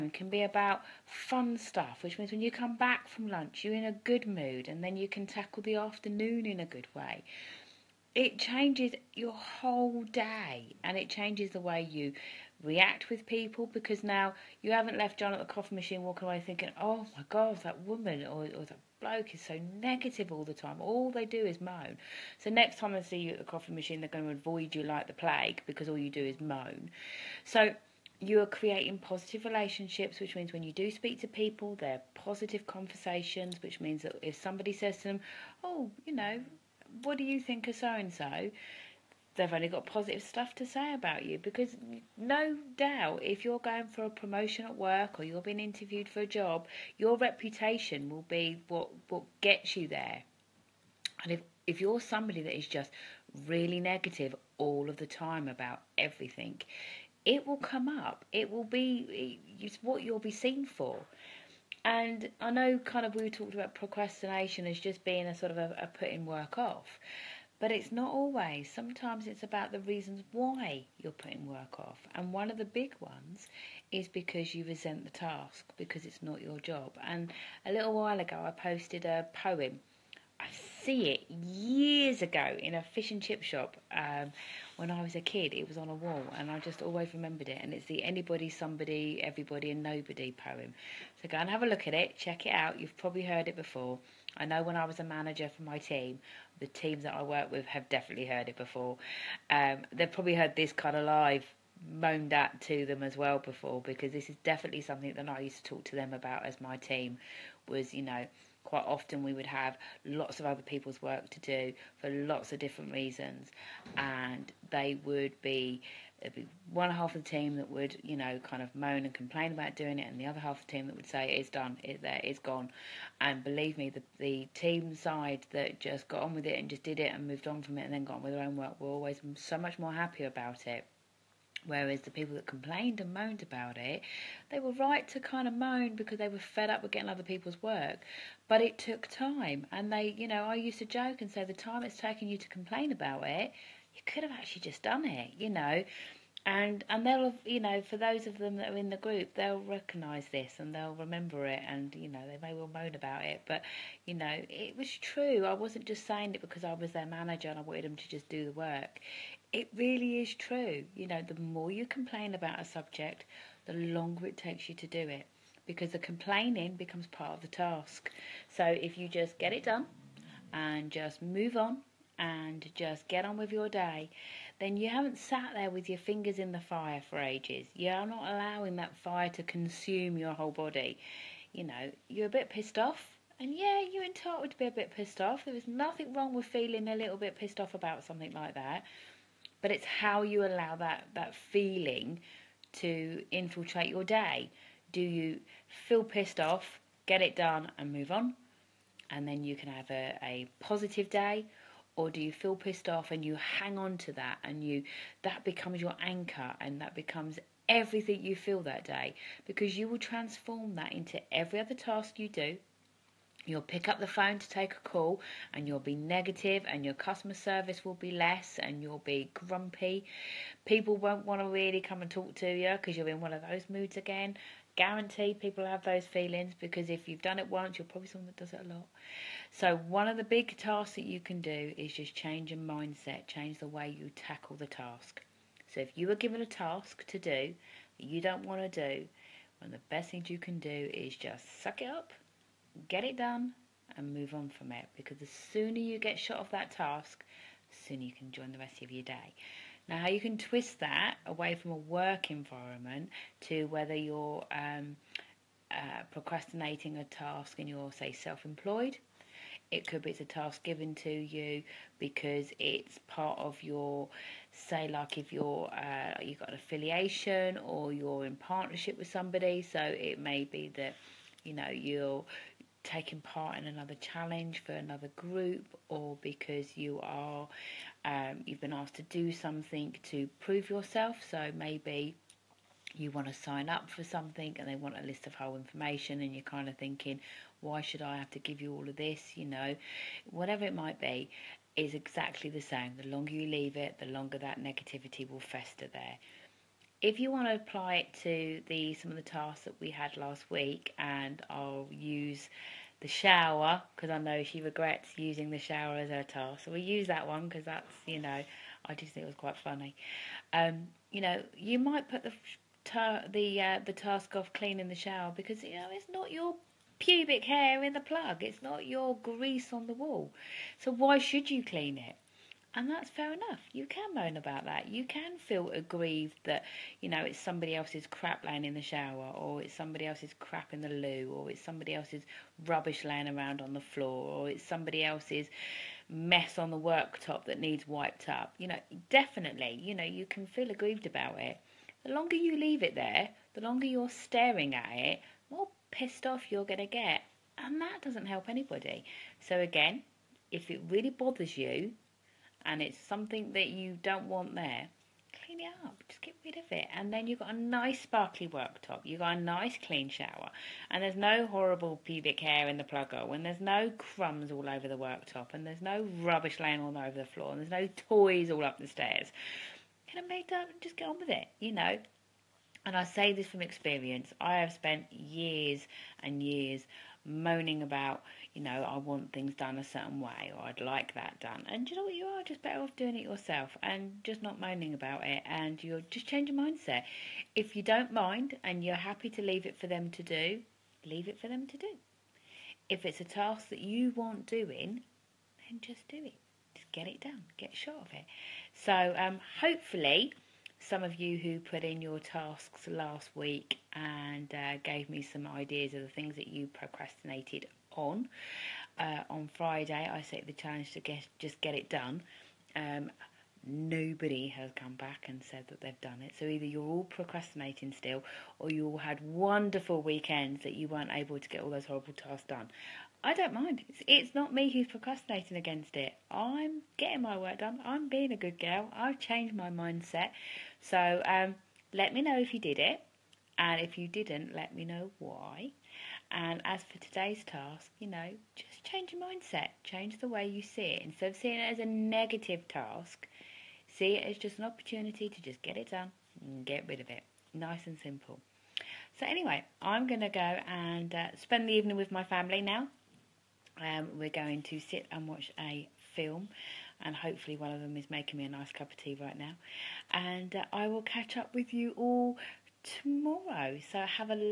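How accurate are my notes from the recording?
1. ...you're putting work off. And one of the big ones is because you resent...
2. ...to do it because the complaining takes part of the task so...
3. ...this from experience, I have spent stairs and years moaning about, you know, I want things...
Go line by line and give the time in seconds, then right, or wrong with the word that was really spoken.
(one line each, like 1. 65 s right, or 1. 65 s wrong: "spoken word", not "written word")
1. 70 s right
2. 164 s wrong: "becomes", not "takes"
3. 373 s wrong: "years", not "stairs".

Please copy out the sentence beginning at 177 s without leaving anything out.
You're not allowing that fire to consume your whole body.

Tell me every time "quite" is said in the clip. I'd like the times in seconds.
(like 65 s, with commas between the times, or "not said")
108 s, 309 s.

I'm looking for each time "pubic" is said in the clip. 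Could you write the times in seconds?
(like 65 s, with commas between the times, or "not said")
316 s, 362 s.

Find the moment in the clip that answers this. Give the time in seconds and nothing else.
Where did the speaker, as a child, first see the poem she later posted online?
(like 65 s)
82 s.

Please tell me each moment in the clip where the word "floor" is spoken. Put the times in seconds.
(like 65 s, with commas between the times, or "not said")
333 s, 367 s.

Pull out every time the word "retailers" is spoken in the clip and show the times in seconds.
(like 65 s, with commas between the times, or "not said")
not said.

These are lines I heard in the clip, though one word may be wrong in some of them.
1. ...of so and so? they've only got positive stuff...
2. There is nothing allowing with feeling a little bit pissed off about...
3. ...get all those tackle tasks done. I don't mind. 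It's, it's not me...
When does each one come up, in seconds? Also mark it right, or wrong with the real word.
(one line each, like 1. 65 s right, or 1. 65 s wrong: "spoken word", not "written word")
1. 37 s right
2. 185 s wrong: "wrong", not "allowing"
3. 421 s wrong: "horrible", not "tackle".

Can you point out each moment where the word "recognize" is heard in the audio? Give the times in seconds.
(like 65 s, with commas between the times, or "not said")
149 s.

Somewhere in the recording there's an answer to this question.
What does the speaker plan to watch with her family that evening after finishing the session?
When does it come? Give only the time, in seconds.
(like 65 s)
455 s.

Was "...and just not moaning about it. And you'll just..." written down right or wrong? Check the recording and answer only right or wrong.
right.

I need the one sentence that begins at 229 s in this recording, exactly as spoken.
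So, one of the big tasks that you can do is just change your mindset, change the way you tackle the task.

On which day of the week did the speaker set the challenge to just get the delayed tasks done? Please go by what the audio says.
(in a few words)
Friday.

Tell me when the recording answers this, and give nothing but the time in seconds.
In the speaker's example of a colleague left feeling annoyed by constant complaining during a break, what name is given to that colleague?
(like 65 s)
15 s.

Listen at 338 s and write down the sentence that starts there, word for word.
You know, definitely, you know, you can feel aggrieved about it.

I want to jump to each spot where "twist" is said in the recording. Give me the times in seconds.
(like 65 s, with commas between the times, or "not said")
250 s.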